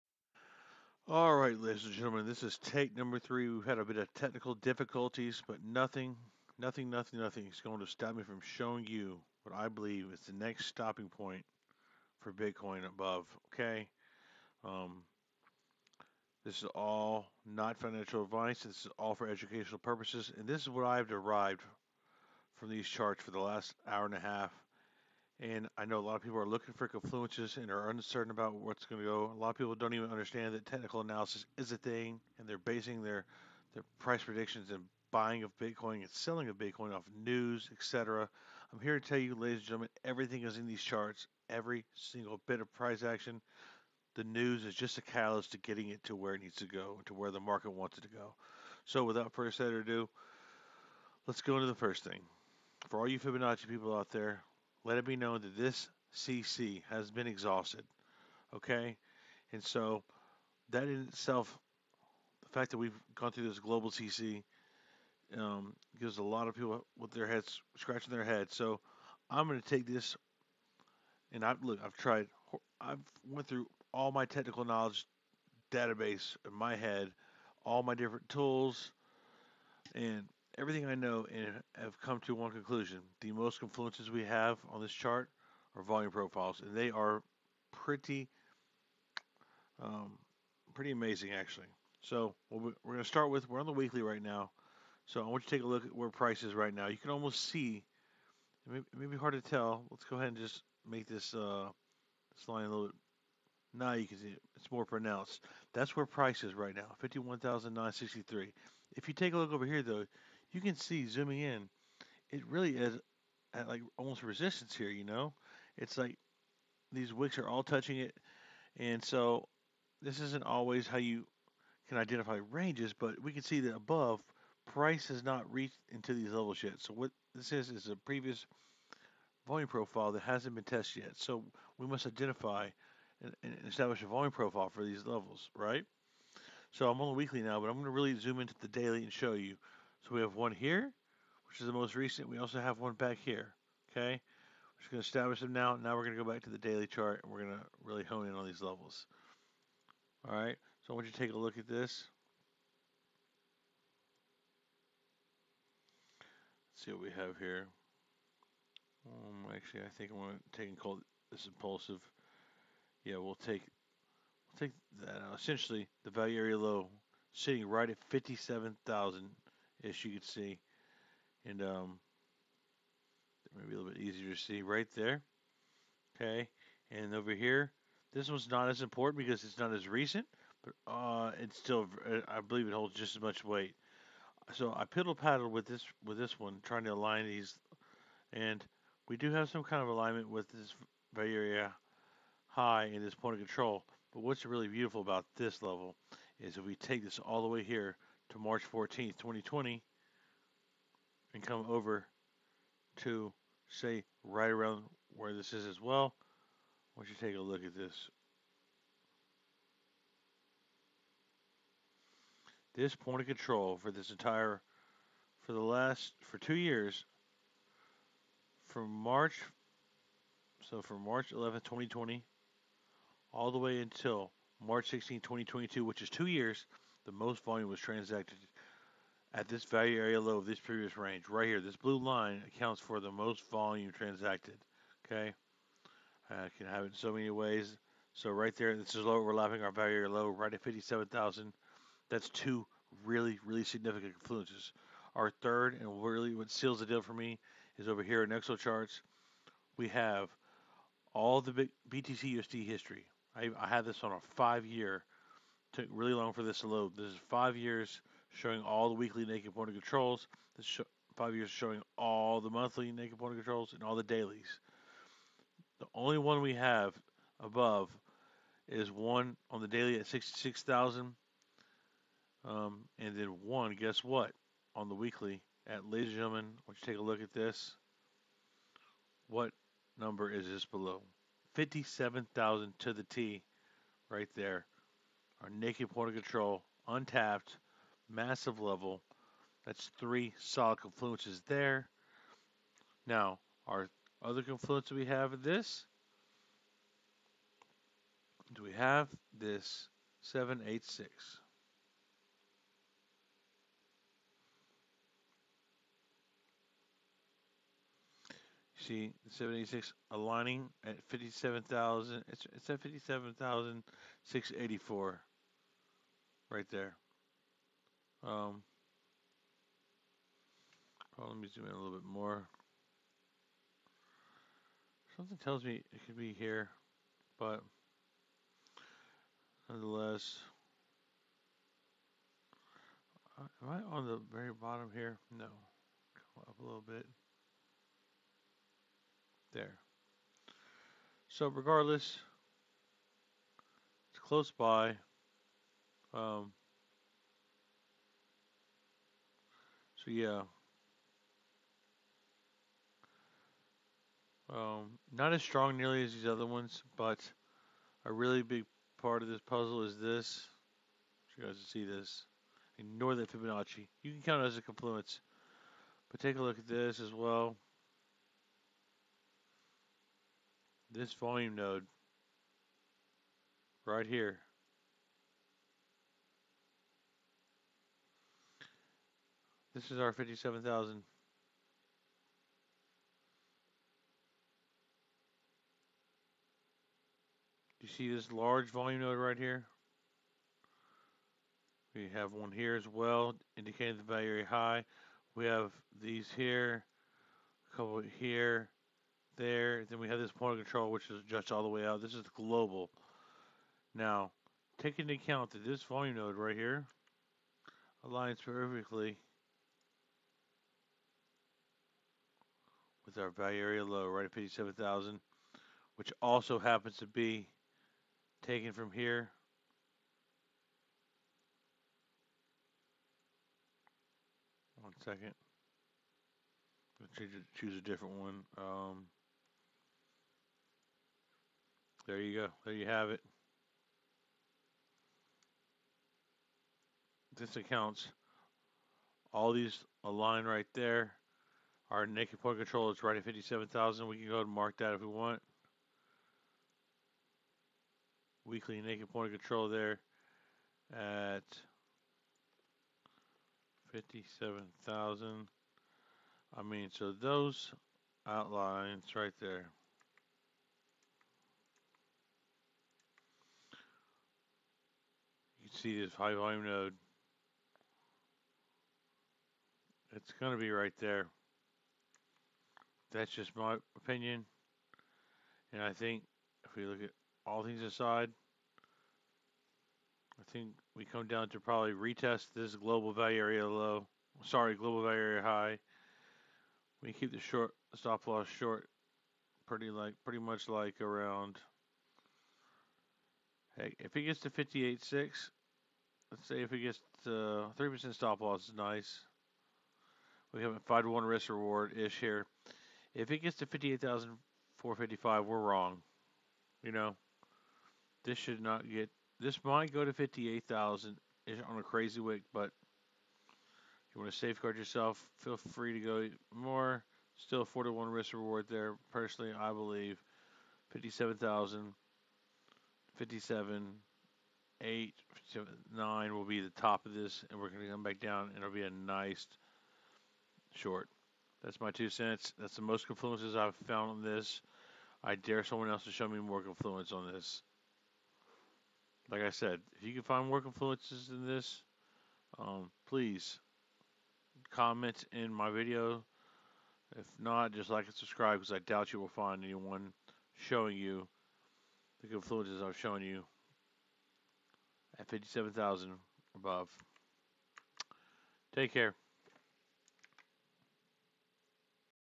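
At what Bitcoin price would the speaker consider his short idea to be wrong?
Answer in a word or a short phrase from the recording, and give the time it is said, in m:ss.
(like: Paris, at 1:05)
58,455, at 8:23.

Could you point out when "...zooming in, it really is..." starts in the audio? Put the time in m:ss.
1:51.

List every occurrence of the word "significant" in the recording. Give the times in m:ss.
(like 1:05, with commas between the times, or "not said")
4:03.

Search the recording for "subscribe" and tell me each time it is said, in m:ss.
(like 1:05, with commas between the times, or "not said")
9:08.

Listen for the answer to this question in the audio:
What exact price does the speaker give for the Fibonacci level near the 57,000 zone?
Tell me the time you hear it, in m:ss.
5:12.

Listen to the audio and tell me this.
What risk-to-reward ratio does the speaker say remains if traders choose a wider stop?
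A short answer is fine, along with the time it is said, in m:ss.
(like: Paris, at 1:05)
4 to 1, at 8:37.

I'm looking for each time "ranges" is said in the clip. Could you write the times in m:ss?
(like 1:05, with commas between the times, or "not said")
2:02, 3:50.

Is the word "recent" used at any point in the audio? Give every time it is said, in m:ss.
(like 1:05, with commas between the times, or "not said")
2:21, 2:59.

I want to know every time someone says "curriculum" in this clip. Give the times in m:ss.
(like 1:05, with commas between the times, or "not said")
not said.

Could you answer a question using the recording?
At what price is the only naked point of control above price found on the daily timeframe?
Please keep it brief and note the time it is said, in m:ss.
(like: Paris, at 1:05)
66,000, at 4:30.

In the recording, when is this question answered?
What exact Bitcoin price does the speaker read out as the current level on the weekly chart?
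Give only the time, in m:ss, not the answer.
1:46.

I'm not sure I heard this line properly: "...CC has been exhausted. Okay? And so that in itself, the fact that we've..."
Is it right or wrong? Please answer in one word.
right.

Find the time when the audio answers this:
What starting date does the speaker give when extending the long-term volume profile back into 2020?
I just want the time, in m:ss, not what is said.
3:18.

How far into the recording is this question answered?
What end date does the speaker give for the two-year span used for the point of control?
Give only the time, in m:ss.
3:44.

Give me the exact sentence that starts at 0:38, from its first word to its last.
I'm here to tell you, ladies and gentlemen, everything is in these charts.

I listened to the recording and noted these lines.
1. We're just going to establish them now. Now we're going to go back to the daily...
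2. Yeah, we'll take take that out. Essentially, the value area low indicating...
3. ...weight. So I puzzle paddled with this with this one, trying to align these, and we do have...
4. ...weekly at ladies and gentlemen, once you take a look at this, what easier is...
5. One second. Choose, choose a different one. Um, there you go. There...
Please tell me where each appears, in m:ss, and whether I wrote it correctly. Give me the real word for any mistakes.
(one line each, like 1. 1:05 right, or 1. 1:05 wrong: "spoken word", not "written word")
1. 2:24 right
2. 2:43 wrong: "sitting", not "indicating"
3. 3:03 wrong: "piddle", not "puzzle"
4. 4:34 wrong: "number", not "easier"
5. 7:04 right.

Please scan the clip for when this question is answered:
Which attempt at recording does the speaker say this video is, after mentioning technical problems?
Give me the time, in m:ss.
0:02.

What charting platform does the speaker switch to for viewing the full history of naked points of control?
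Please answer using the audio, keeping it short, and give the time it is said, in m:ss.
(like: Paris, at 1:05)
Exocharts, at 4:08.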